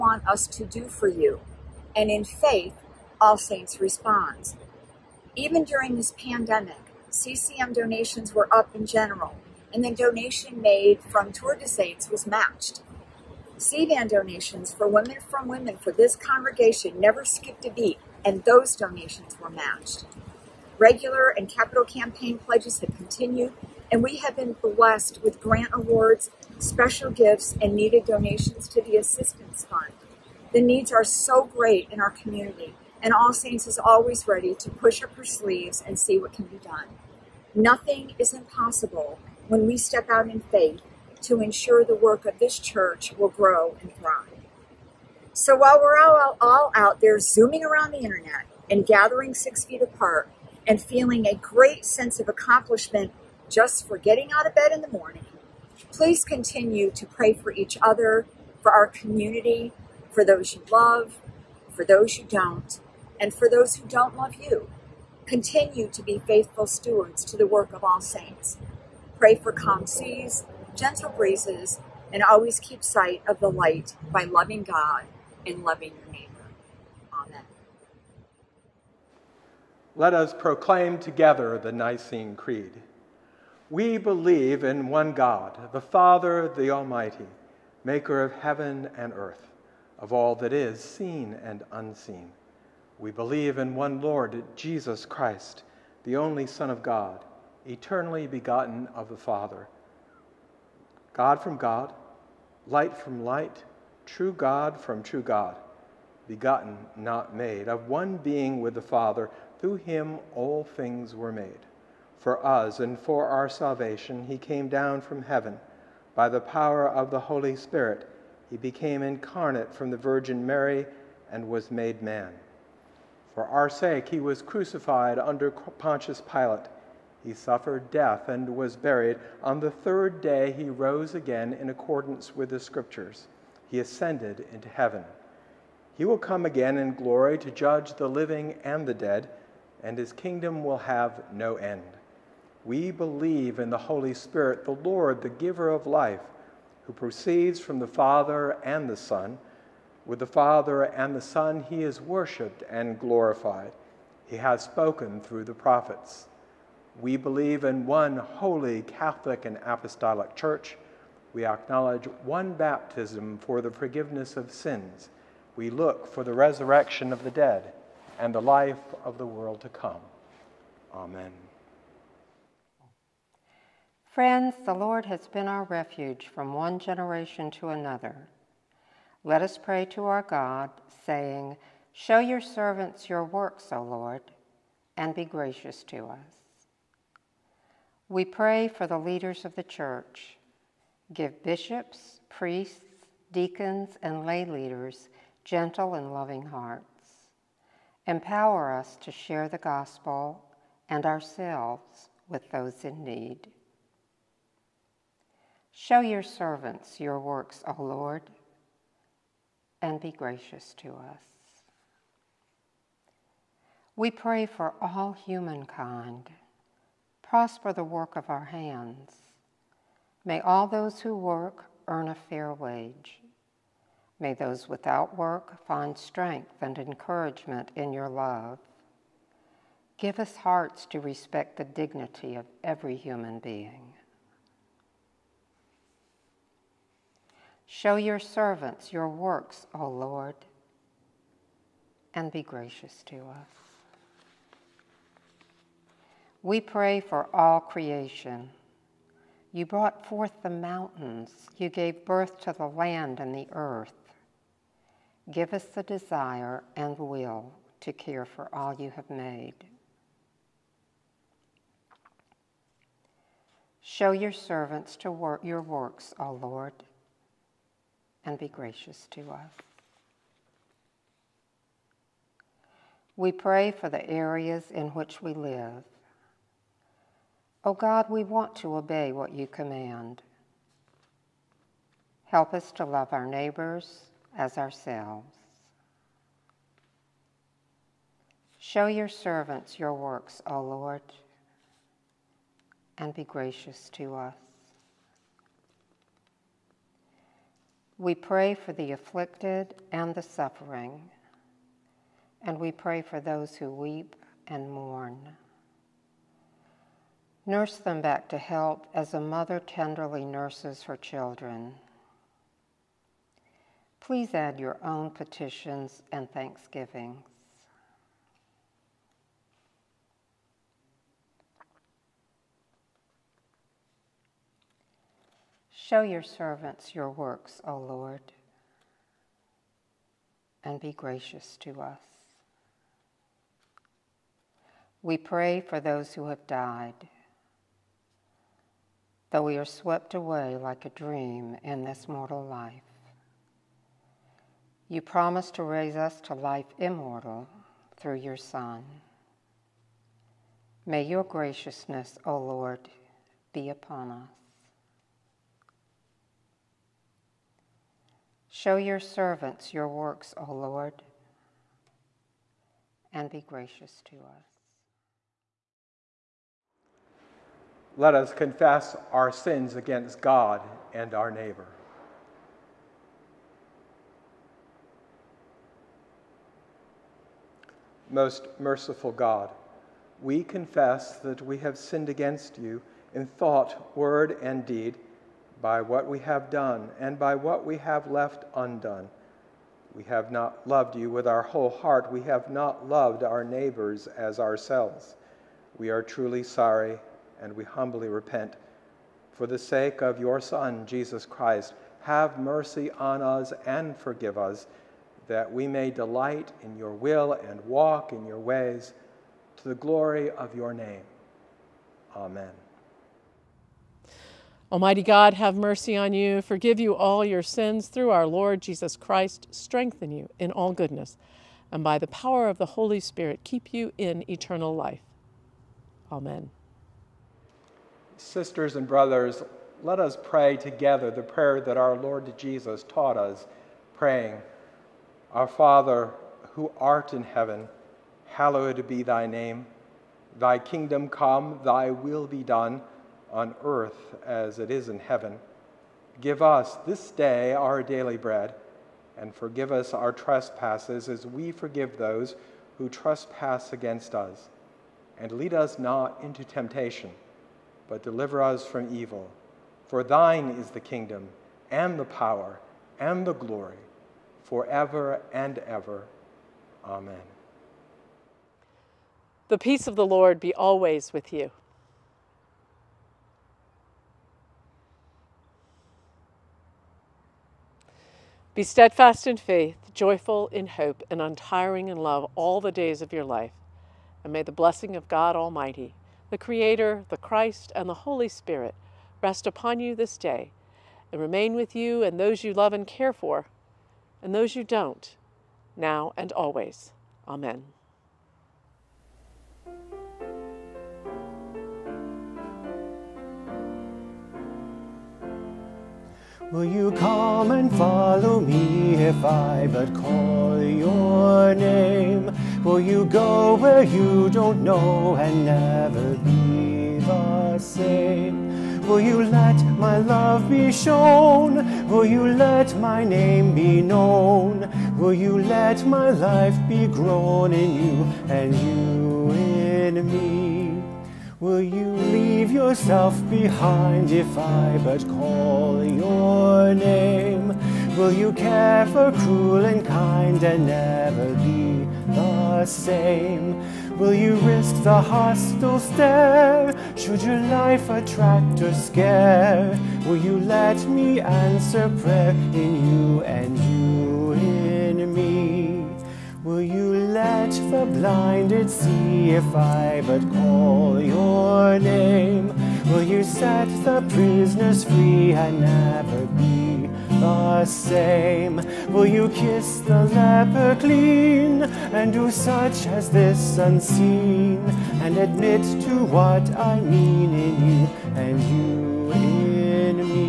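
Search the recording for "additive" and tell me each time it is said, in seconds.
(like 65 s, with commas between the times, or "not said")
not said.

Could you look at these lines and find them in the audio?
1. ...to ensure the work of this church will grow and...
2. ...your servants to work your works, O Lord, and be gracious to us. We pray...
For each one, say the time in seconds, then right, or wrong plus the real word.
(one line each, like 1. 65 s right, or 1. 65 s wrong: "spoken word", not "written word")
1. 41 s right
2. 264 s right.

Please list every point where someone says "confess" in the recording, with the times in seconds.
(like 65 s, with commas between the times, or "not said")
368 s, 380 s.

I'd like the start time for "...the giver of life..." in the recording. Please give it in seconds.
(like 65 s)
145 s.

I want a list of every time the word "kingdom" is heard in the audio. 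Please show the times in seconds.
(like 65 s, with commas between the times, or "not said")
140 s, 440 s, 460 s.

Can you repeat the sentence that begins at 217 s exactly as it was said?
Prosper the work of our hands.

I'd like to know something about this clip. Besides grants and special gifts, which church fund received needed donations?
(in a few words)
Assistance Fund.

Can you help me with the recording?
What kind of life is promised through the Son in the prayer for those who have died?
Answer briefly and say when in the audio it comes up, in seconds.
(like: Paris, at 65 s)
life immortal, at 346 s.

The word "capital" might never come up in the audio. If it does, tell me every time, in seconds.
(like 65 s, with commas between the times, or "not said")
21 s.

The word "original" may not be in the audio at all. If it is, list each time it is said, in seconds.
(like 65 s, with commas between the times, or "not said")
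not said.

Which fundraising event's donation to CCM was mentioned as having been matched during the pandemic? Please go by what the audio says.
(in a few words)
Tour de Saints.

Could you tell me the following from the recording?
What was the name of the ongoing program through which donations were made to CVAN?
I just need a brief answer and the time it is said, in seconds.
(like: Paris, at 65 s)
Women from Women, at 14 s.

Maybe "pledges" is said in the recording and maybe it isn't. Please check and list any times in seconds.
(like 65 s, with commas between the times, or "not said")
22 s.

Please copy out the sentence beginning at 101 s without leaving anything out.
God from God, light from light, true God from true God, begotten, not made, of one being with the Father.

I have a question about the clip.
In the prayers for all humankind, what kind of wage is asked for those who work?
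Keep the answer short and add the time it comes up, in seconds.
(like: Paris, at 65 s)
a fair wage, at 222 s.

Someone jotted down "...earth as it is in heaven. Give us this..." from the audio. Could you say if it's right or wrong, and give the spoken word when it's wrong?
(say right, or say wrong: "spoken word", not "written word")
right.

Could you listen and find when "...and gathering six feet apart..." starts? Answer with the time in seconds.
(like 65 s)
48 s.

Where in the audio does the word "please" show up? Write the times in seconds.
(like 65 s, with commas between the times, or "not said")
55 s, 314 s.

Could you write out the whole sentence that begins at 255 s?
Give us the desire and will to care for all you have made.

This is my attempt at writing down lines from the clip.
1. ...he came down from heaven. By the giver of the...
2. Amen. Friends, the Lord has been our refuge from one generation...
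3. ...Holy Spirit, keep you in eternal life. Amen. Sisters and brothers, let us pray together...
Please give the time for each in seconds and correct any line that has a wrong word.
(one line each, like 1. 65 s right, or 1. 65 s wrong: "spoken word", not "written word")
1. 114 s wrong: "power", not "giver"
2. 170 s right
3. 422 s right.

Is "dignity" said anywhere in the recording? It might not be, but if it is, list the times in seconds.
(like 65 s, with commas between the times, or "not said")
231 s.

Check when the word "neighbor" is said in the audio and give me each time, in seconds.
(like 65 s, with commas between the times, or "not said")
76 s, 283 s, 371 s, 393 s.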